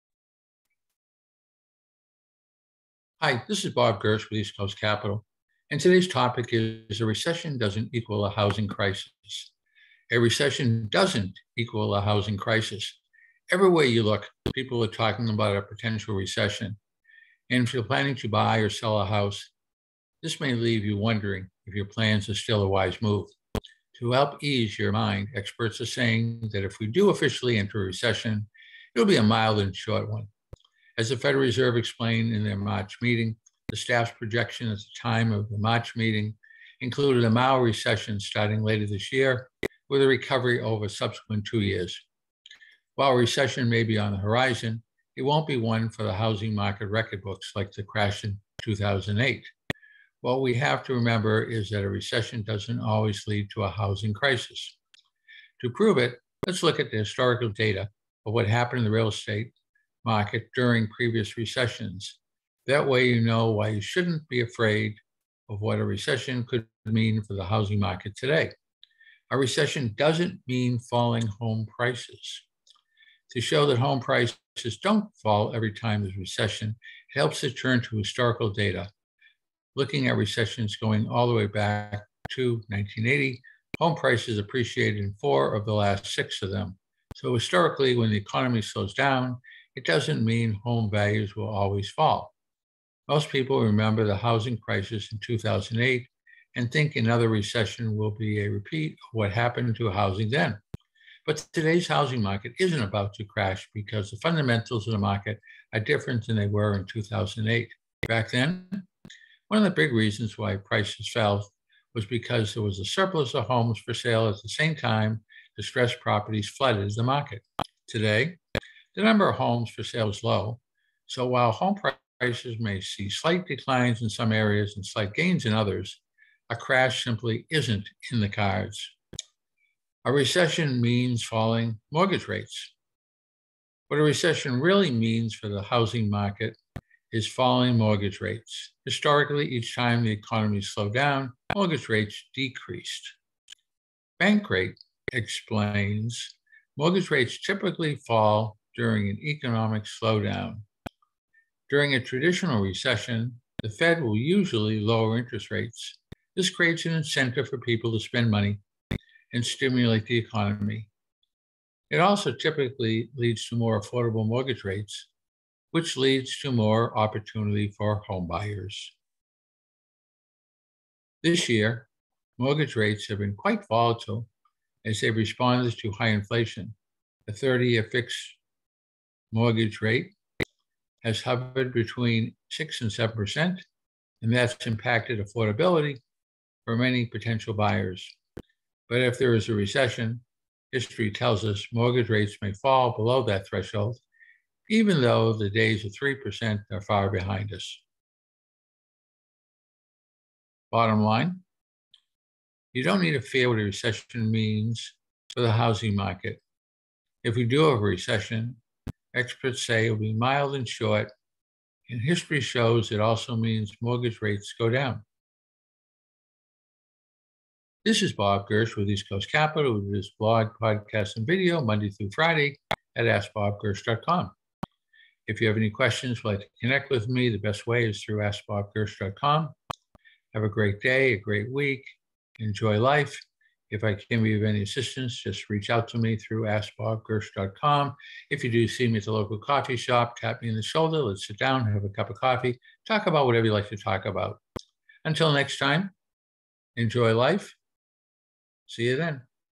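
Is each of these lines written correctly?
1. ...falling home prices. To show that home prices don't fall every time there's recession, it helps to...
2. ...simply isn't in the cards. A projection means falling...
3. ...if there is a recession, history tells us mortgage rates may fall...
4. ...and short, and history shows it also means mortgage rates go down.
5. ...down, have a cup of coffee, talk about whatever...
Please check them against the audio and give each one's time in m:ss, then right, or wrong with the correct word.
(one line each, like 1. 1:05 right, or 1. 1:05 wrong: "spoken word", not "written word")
1. 1:10 right
2. 2:07 wrong: "recession", not "projection"
3. 3:09 right
4. 3:30 right
5. 4:01 right.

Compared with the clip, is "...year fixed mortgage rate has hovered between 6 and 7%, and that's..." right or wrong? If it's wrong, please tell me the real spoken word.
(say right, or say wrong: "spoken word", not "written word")
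right.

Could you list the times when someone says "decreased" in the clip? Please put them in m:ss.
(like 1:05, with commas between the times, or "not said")
2:22.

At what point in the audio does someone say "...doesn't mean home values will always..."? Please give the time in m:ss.
1:29.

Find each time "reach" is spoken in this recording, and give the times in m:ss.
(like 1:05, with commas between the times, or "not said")
3:55.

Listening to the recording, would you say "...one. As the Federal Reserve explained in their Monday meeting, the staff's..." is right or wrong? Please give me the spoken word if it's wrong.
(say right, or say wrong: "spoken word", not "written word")
wrong: "March", not "Monday".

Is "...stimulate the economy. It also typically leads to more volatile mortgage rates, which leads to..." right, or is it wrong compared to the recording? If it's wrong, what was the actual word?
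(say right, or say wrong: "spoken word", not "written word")
wrong: "affordable", not "volatile".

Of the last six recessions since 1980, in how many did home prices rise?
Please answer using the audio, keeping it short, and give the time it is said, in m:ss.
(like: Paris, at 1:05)
4, at 1:25.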